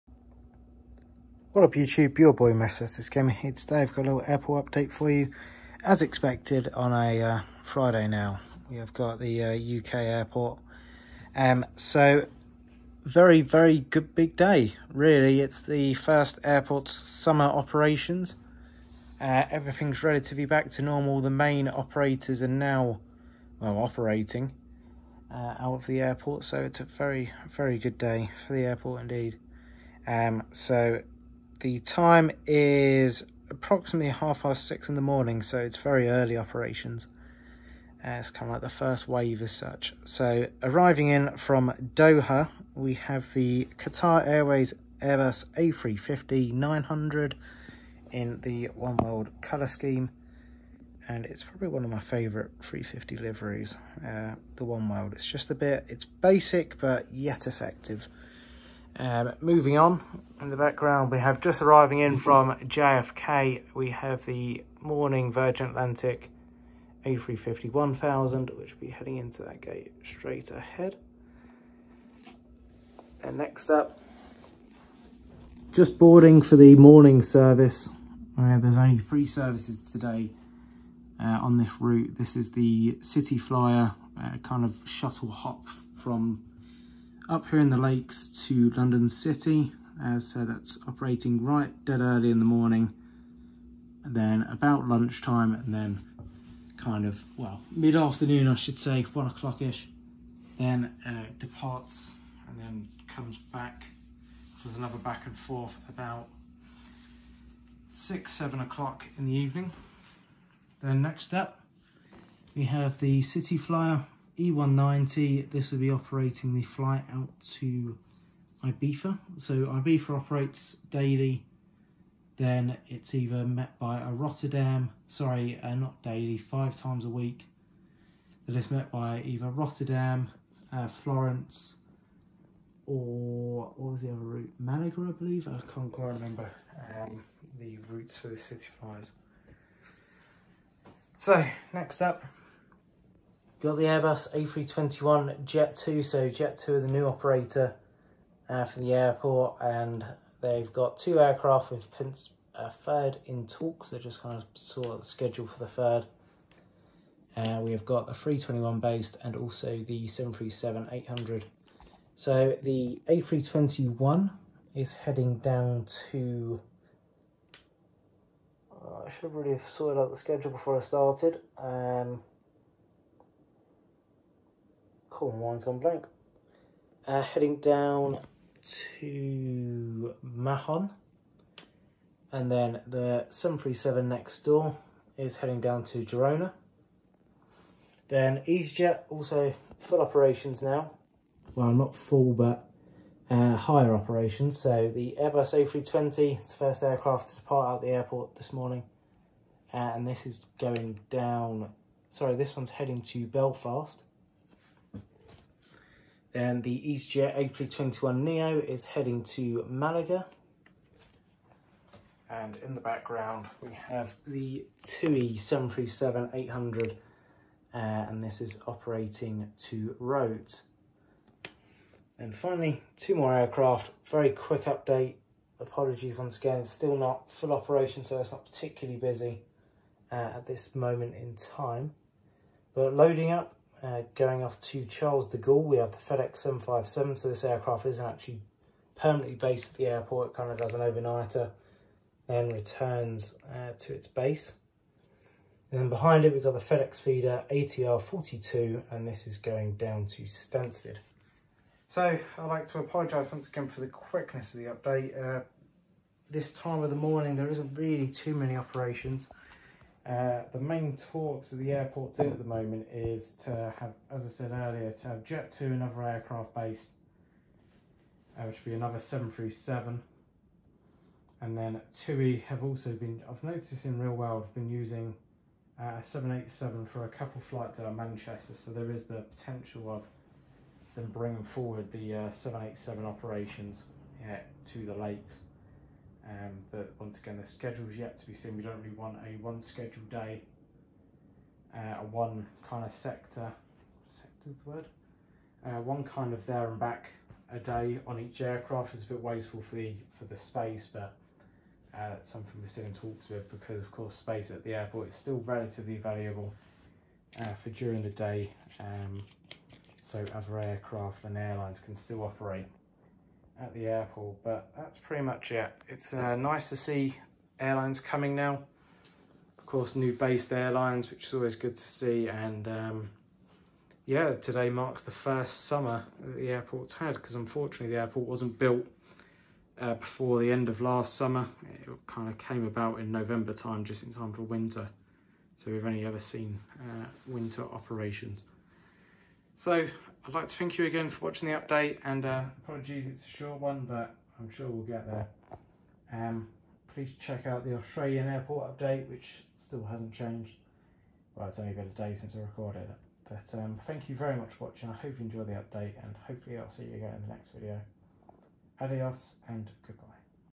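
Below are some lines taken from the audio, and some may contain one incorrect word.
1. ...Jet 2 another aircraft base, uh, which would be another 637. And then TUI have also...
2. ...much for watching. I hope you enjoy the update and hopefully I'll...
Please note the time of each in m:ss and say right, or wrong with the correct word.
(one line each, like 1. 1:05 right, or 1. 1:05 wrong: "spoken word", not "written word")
1. 4:25 wrong: "737", not "637"
2. 5:54 right.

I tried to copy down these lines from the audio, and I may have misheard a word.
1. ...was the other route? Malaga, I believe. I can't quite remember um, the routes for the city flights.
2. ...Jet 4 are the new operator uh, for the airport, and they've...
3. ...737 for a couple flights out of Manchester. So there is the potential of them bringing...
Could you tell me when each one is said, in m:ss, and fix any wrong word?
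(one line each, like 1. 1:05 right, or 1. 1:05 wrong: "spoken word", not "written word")
1. 2:13 right
2. 2:26 wrong: "2", not "4"
3. 4:36 wrong: "787", not "737".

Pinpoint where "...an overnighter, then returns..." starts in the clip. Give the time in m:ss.
4:00.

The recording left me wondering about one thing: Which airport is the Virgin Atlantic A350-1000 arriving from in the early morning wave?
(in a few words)
JFK.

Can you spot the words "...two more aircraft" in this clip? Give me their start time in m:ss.
3:42.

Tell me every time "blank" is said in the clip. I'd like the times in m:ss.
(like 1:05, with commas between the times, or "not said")
2:55.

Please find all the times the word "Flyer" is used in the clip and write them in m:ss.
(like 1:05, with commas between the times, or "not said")
1:23, 1:53.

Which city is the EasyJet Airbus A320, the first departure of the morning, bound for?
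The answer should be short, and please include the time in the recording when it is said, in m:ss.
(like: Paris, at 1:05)
Belfast, at 3:23.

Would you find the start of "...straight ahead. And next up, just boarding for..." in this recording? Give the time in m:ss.
1:10.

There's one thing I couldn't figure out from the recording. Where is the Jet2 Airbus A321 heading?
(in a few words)
Mahon.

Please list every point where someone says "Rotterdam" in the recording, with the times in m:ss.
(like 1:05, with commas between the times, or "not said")
2:04, 2:09.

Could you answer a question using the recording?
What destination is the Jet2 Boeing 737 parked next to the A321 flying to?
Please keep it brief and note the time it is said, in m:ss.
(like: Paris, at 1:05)
Girona, at 3:06.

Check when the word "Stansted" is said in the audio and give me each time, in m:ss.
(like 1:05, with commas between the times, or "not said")
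4:10.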